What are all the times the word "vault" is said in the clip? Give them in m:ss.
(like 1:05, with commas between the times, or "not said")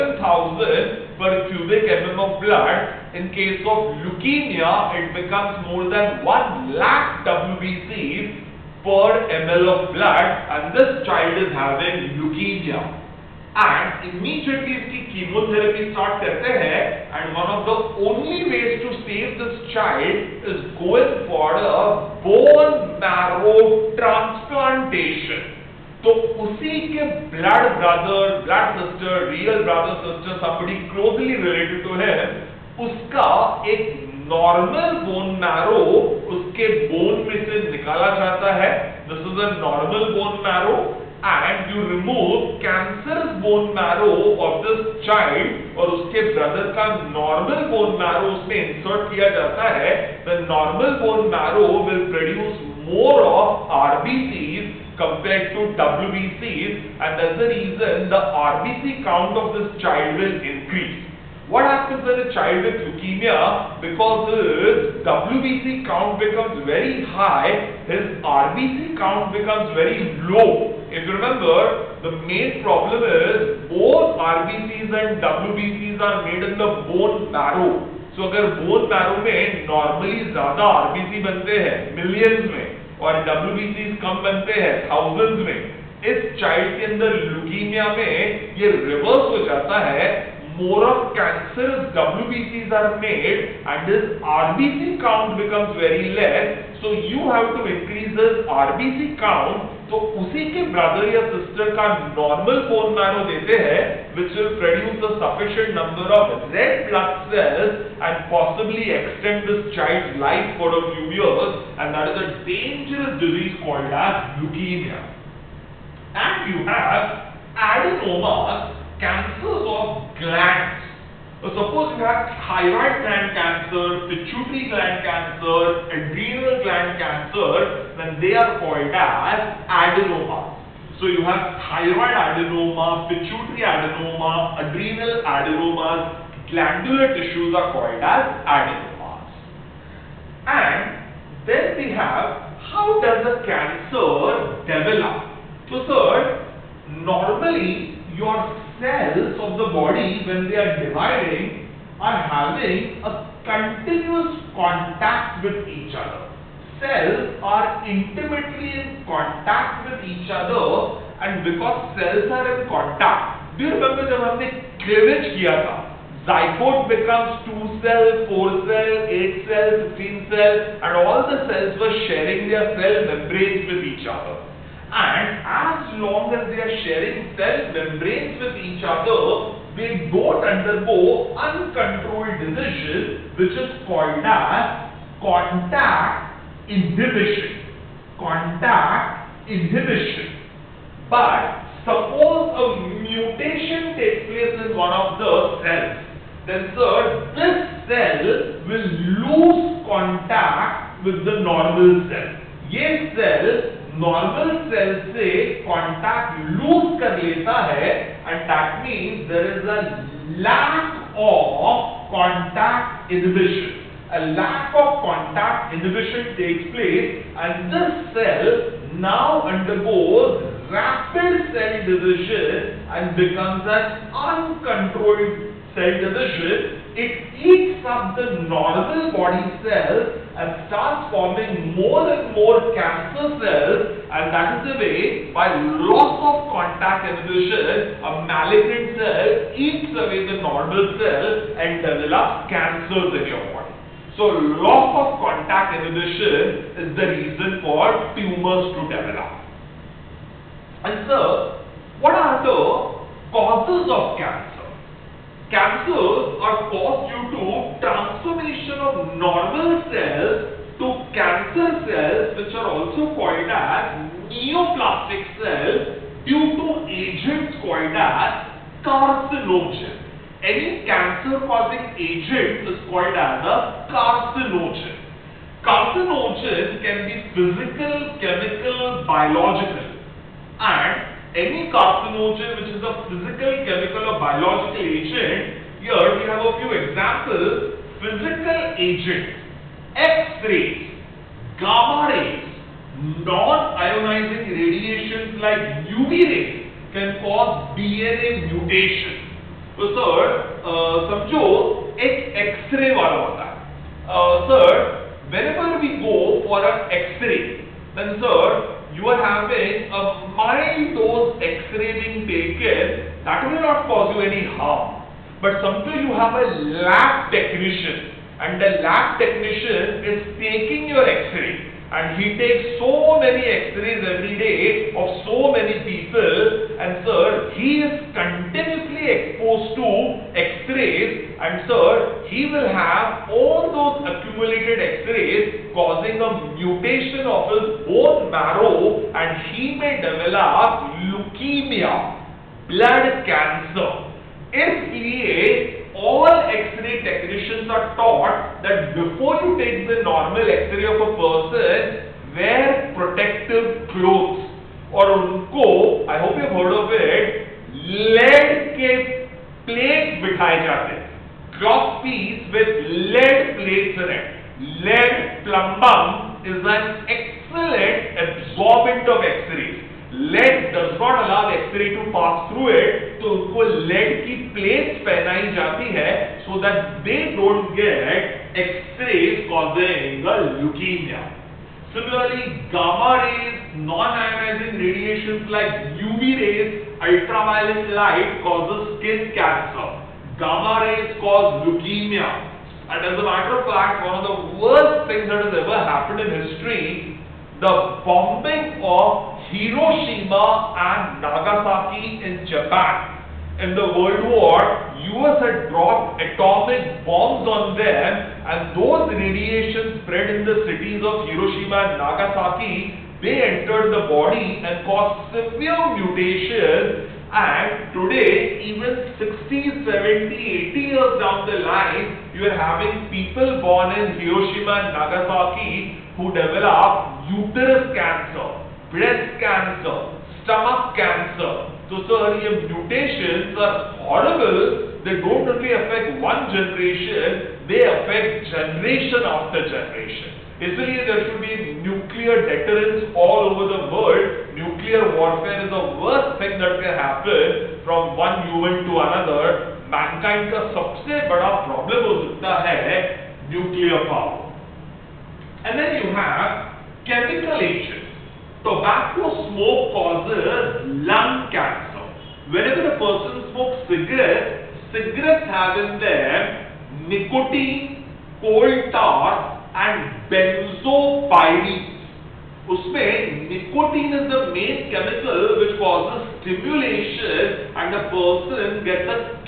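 not said.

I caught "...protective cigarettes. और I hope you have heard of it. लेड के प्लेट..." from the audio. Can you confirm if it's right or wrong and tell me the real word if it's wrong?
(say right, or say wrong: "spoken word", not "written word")
wrong: "clothes", not "cigarettes".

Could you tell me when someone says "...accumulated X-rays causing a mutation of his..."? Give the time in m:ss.
5:34.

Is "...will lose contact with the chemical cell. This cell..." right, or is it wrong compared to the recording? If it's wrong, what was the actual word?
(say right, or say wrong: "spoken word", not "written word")
wrong: "normal", not "chemical".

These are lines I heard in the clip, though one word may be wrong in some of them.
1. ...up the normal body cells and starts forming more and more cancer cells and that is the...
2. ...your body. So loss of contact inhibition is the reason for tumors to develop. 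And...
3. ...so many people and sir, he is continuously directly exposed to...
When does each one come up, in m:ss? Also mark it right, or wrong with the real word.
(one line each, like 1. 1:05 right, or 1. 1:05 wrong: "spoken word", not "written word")
1. 3:47 right
2. 4:03 right
3. 5:25 right.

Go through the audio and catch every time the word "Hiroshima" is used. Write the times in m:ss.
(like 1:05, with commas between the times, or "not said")
6:39, 6:51, 7:04.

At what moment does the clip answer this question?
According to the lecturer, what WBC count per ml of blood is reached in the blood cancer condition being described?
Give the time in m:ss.
0:05.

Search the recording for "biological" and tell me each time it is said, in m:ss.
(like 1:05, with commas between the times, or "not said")
4:39, 4:44.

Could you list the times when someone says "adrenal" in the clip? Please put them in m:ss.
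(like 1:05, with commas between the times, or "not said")
2:05, 2:14.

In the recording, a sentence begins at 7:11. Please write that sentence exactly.
So sir, your mutations are horrible.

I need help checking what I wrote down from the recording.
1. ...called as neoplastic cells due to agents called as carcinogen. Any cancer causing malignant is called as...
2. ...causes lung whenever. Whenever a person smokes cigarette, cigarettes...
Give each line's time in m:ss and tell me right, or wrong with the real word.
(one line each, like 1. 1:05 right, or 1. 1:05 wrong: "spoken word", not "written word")
1. 4:23 wrong: "agent", not "malignant"
2. 7:39 wrong: "cancer", not "whenever".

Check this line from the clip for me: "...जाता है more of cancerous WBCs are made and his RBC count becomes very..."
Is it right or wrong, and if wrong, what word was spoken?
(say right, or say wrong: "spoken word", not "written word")
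right.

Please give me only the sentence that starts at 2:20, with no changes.
And then we have how does a cancer develop?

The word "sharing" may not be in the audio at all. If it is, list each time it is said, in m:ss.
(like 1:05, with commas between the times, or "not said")
2:52, 2:56.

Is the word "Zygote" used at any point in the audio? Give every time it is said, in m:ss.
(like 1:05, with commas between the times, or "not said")
2:46.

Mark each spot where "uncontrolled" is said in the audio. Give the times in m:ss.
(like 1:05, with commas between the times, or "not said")
3:01, 3:44.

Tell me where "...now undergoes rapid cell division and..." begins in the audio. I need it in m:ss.
3:39.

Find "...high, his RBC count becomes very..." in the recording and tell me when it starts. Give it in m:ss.
1:07.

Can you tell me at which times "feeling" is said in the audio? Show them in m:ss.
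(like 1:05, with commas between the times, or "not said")
not said.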